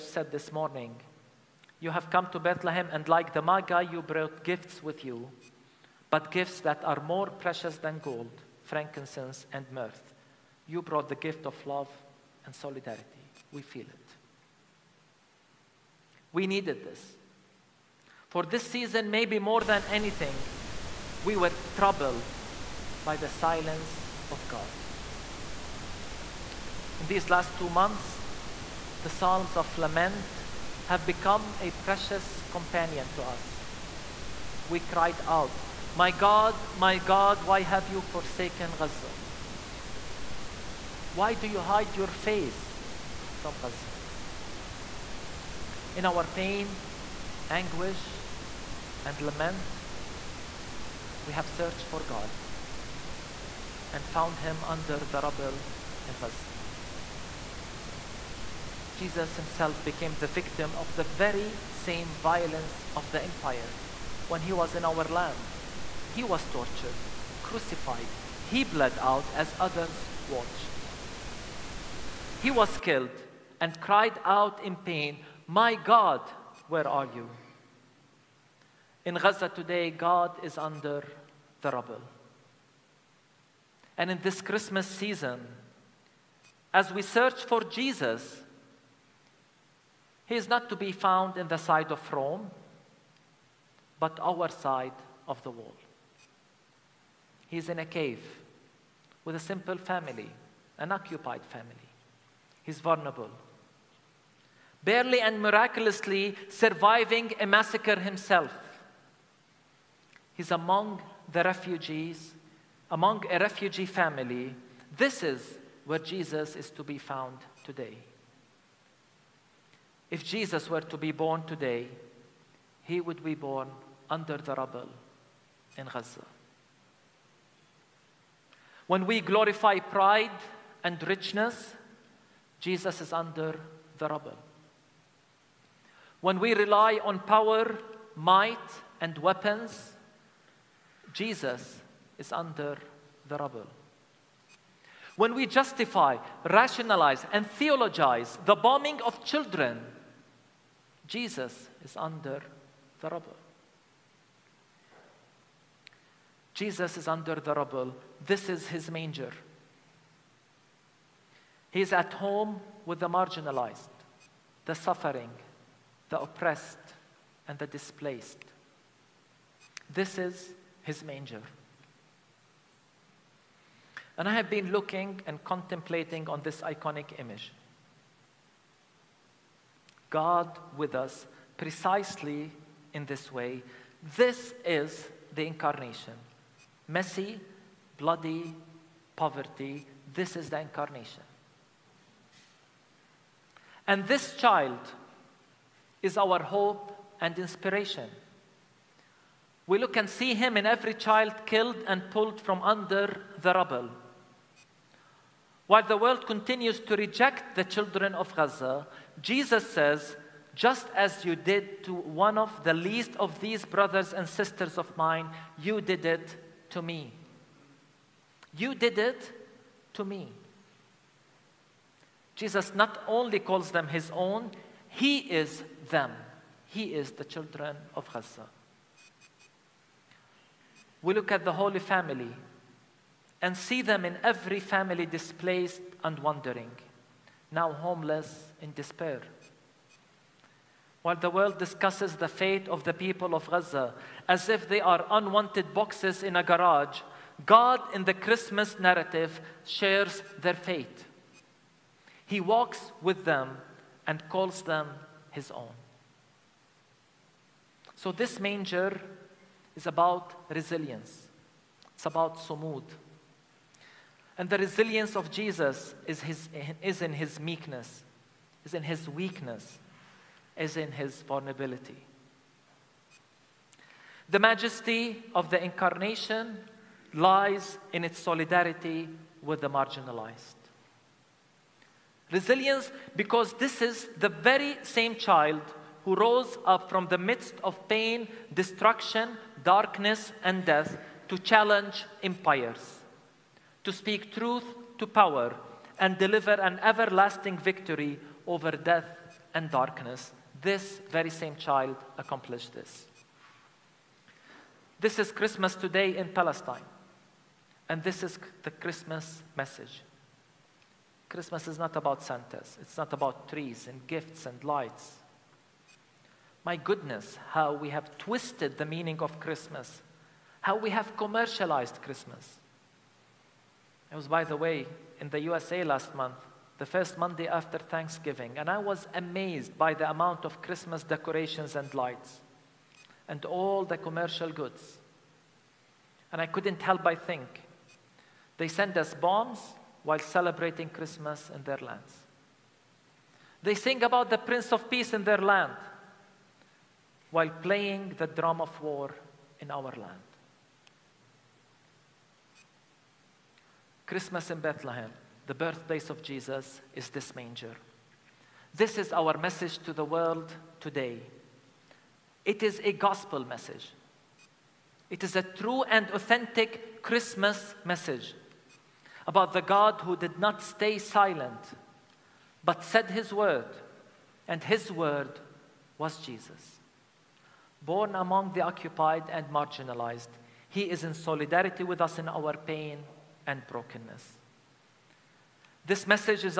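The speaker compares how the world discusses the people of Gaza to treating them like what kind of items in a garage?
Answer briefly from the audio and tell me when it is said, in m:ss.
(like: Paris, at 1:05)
unwanted boxes, at 4:05.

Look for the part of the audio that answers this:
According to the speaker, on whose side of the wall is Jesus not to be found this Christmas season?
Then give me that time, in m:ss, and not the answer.
1:32.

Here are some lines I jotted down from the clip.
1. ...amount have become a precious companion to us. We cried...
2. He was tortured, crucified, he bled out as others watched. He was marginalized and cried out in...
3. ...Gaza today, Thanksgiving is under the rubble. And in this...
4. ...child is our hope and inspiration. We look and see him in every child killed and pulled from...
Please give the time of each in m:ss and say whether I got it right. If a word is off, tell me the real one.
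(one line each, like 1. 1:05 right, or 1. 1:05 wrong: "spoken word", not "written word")
1. 0:29 wrong: "lament", not "amount"
2. 1:06 wrong: "killed", not "marginalized"
3. 1:19 wrong: "God", not "Thanksgiving"
4. 3:14 right.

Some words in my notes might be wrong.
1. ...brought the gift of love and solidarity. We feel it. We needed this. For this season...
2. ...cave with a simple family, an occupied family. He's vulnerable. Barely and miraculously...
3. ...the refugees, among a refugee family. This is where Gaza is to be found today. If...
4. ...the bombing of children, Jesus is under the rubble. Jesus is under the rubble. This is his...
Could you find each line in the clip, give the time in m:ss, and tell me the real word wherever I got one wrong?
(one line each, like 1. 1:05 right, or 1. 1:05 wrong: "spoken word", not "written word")
1. 0:10 right
2. 1:37 right
3. 1:51 wrong: "Jesus", not "Gaza"
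4. 2:28 right.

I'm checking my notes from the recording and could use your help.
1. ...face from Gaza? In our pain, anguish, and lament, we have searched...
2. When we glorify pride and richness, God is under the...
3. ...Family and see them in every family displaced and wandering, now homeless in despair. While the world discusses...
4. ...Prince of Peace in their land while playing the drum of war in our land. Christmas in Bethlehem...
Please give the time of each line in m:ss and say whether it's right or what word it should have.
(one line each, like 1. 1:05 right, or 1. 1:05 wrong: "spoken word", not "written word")
1. 0:42 right
2. 2:08 wrong: "Jesus", not "God"
3. 3:51 right
4. 5:44 right.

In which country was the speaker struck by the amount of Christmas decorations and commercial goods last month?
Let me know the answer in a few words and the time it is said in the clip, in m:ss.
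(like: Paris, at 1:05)
USA, at 5:25.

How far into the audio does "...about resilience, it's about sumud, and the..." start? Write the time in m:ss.
4:19.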